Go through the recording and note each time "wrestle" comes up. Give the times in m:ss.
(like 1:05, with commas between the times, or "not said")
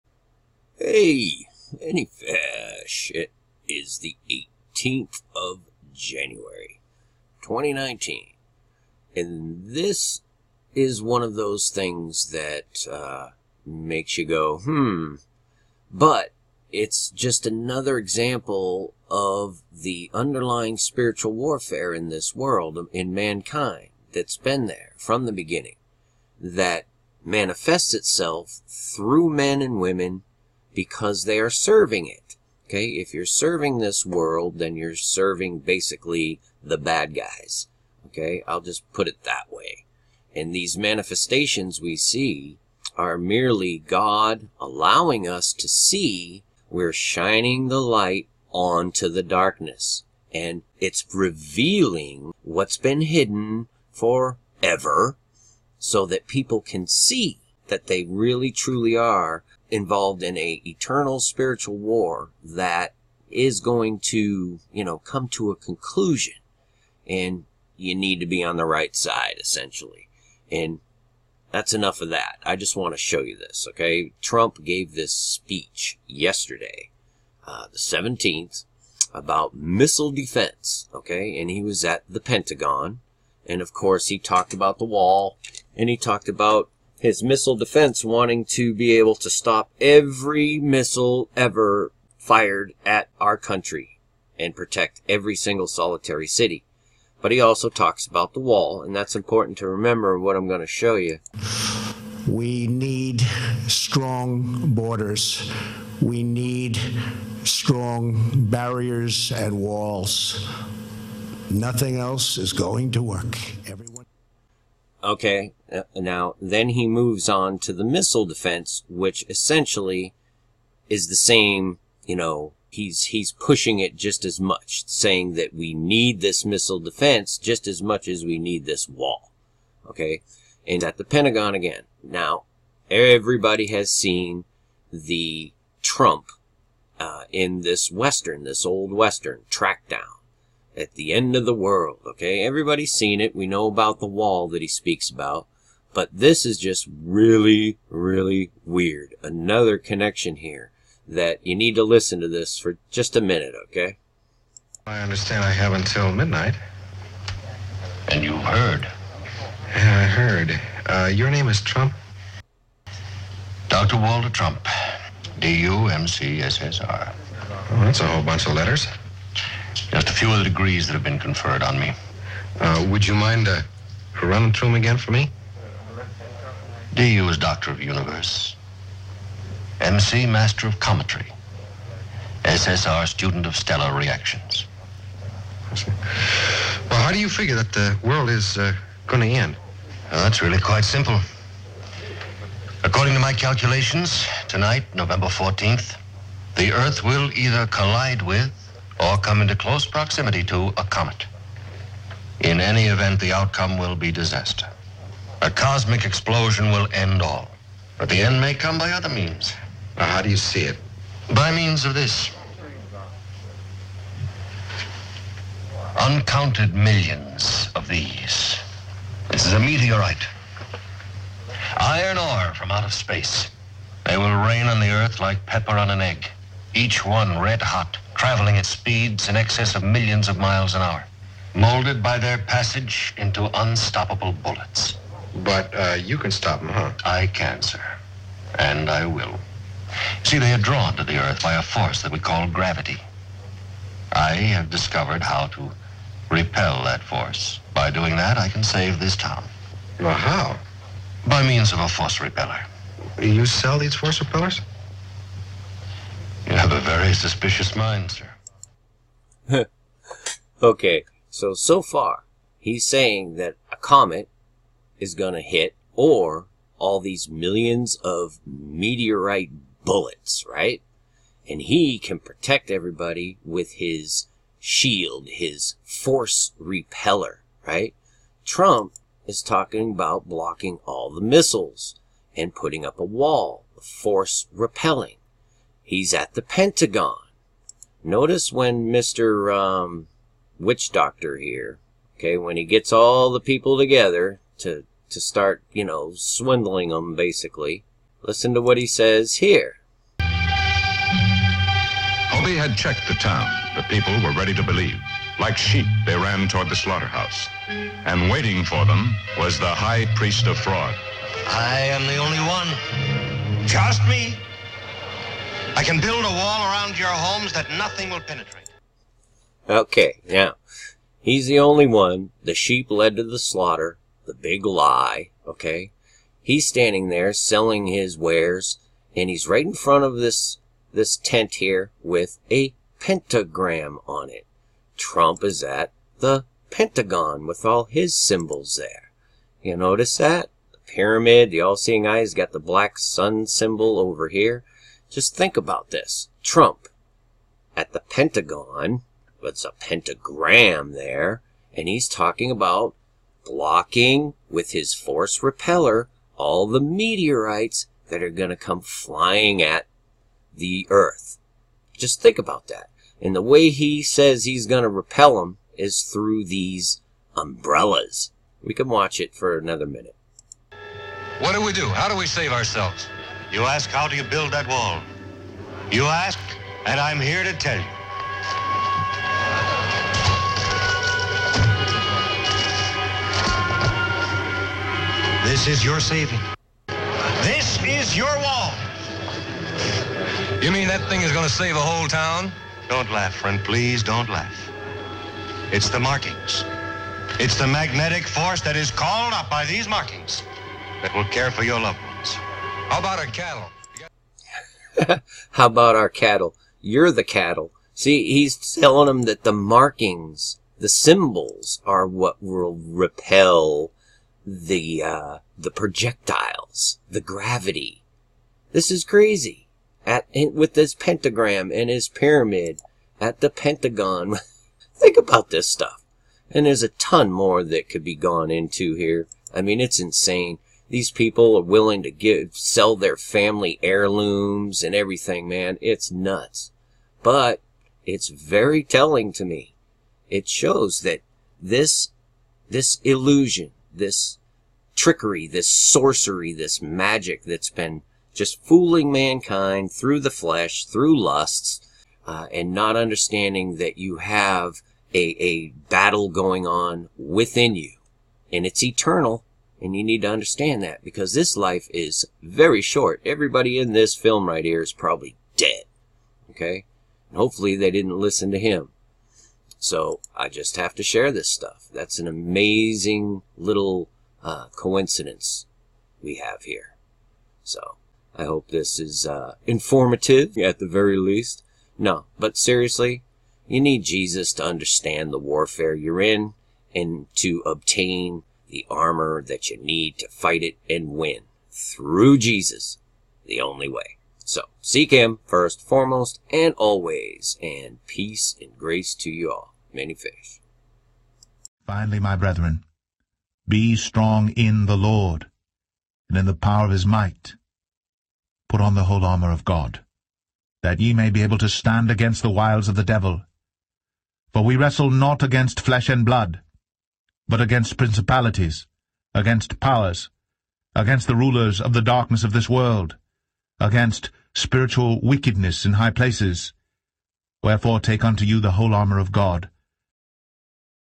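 8:34.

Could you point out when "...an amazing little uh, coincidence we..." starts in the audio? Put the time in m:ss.
7:52.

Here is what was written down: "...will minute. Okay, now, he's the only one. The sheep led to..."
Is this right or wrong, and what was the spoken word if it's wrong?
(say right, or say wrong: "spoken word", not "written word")
wrong: "penetrate", not "minute".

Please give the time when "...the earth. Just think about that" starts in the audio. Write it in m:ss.
6:00.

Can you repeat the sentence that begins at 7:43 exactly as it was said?
Everybody in this film right here is probably dead.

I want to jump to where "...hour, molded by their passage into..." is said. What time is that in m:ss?
3:50.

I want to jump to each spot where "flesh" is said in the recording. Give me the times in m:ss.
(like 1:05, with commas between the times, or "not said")
7:30, 8:35.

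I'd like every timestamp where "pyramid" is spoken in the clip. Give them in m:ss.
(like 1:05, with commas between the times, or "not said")
5:40, 7:02.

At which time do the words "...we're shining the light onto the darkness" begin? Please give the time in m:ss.
0:46.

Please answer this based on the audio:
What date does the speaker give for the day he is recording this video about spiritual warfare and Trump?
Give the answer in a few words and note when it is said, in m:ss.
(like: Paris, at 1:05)
January 18, 2019, at 0:04.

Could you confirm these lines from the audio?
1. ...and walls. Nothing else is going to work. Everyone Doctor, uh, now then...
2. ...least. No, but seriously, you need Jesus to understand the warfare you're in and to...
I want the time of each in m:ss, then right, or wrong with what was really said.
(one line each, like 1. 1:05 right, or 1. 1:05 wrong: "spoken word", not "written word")
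1. 1:49 wrong: "Okay", not "Doctor"
2. 8:01 right.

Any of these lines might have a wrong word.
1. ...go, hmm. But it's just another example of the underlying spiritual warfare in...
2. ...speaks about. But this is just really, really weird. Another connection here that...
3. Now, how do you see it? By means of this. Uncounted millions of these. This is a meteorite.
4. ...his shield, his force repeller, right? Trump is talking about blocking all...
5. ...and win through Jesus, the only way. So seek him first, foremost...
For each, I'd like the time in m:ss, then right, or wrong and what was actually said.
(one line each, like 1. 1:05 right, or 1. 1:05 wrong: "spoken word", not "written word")
1. 0:14 right
2. 2:24 right
3. 3:29 right
4. 4:33 right
5. 8:10 right.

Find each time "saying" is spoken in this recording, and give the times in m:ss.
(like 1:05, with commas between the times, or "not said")
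2:04, 4:22.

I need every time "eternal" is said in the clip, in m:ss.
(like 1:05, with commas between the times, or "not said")
1:00, 7:38.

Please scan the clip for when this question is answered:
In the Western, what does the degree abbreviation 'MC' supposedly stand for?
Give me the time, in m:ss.
3:00.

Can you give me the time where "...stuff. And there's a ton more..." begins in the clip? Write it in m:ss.
7:05.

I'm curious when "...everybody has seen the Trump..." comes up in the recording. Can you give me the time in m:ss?
2:12.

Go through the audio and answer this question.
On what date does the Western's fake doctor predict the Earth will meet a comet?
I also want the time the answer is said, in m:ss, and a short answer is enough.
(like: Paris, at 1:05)
November 14th, at 3:14.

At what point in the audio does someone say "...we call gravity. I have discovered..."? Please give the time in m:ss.
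4:02.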